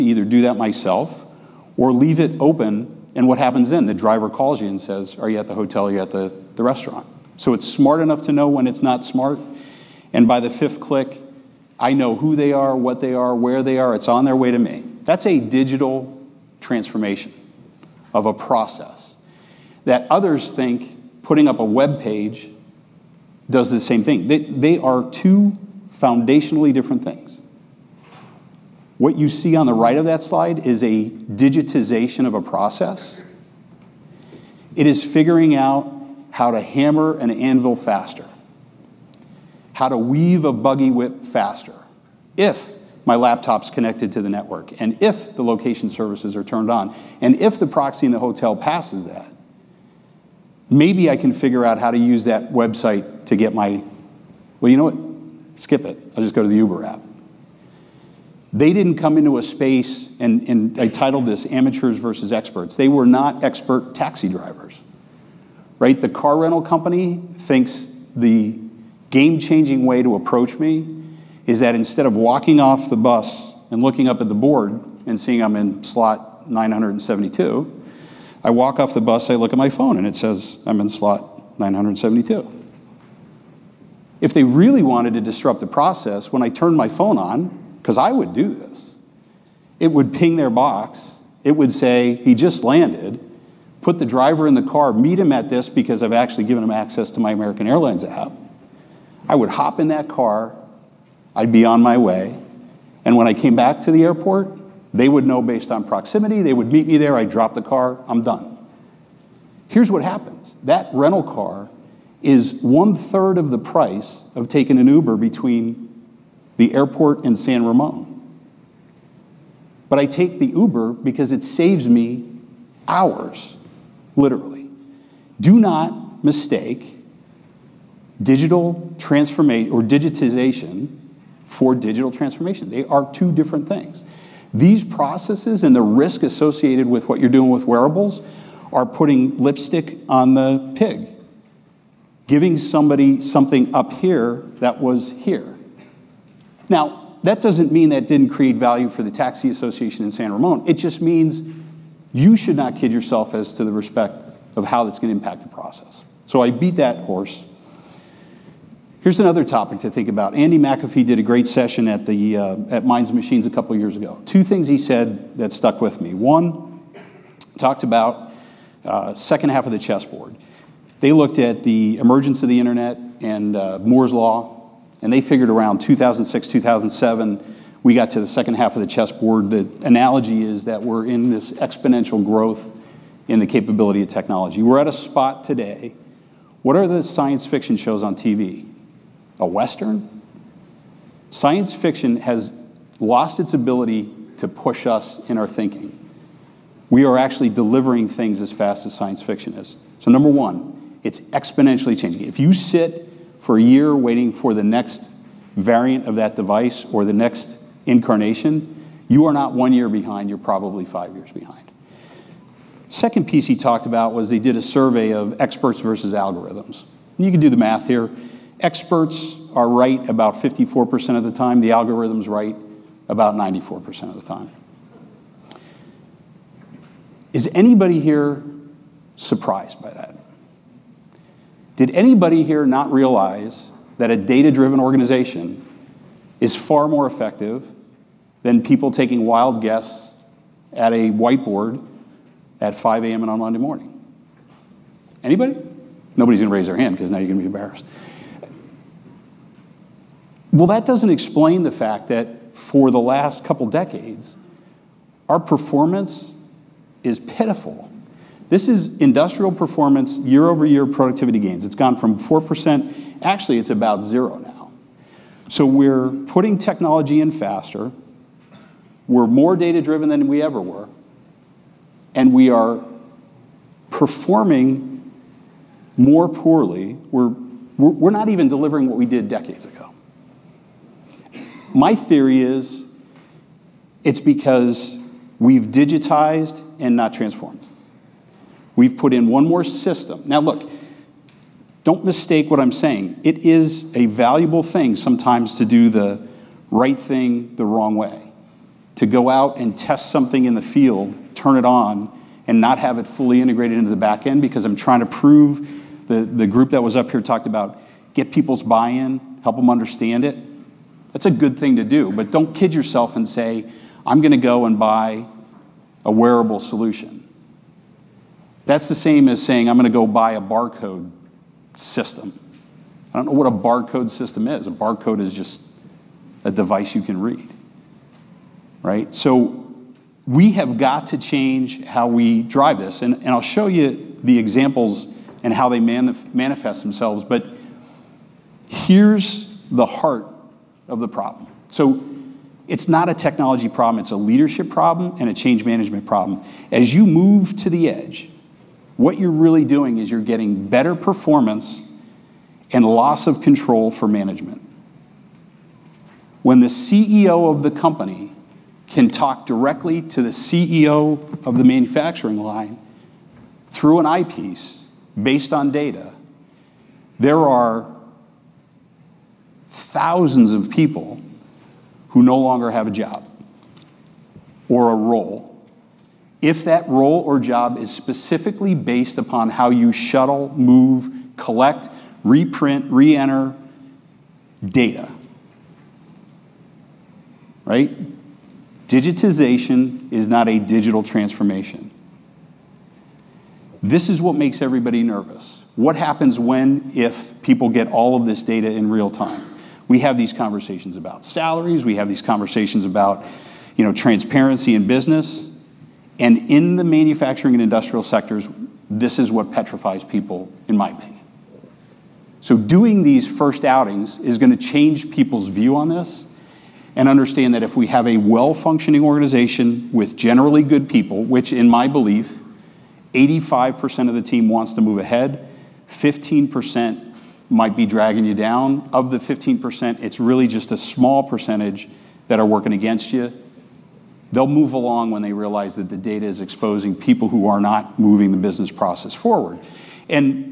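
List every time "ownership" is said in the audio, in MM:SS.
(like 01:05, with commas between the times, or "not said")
not said.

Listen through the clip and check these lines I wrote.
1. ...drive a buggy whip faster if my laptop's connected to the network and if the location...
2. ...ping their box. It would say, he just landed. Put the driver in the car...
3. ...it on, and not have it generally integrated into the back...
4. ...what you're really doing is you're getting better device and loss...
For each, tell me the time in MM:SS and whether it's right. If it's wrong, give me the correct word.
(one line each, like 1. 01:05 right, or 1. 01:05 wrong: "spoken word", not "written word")
1. 00:39 wrong: "weave", not "drive"
2. 01:30 right
3. 05:01 wrong: "fully", not "generally"
4. 05:48 wrong: "performance", not "device".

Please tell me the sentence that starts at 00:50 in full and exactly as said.
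Maybe I can figure out how to use that website to get my, well, you know what?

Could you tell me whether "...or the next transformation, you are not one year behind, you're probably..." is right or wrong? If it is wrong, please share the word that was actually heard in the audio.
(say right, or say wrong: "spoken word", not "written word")
wrong: "incarnation", not "transformation".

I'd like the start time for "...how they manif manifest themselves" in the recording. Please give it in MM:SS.
05:35.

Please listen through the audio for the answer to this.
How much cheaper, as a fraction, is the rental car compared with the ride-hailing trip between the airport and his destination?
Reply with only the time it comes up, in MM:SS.
01:52.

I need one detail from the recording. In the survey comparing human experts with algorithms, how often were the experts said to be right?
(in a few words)
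54%.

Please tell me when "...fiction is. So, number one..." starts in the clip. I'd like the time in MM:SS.
03:19.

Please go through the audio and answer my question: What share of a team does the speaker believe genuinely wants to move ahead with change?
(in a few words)
85%.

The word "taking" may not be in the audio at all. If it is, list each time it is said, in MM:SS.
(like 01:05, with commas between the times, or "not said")
01:54, 03:58.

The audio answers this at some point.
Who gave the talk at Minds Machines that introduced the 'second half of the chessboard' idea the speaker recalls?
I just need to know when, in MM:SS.
02:40.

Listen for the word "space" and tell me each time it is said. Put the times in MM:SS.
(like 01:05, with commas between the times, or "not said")
00:59.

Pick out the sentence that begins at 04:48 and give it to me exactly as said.
We've put in one more system.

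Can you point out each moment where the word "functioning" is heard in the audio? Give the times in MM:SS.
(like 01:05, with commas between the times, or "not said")
06:58.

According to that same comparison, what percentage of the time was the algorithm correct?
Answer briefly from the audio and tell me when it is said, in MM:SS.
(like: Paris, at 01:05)
94%, at 03:43.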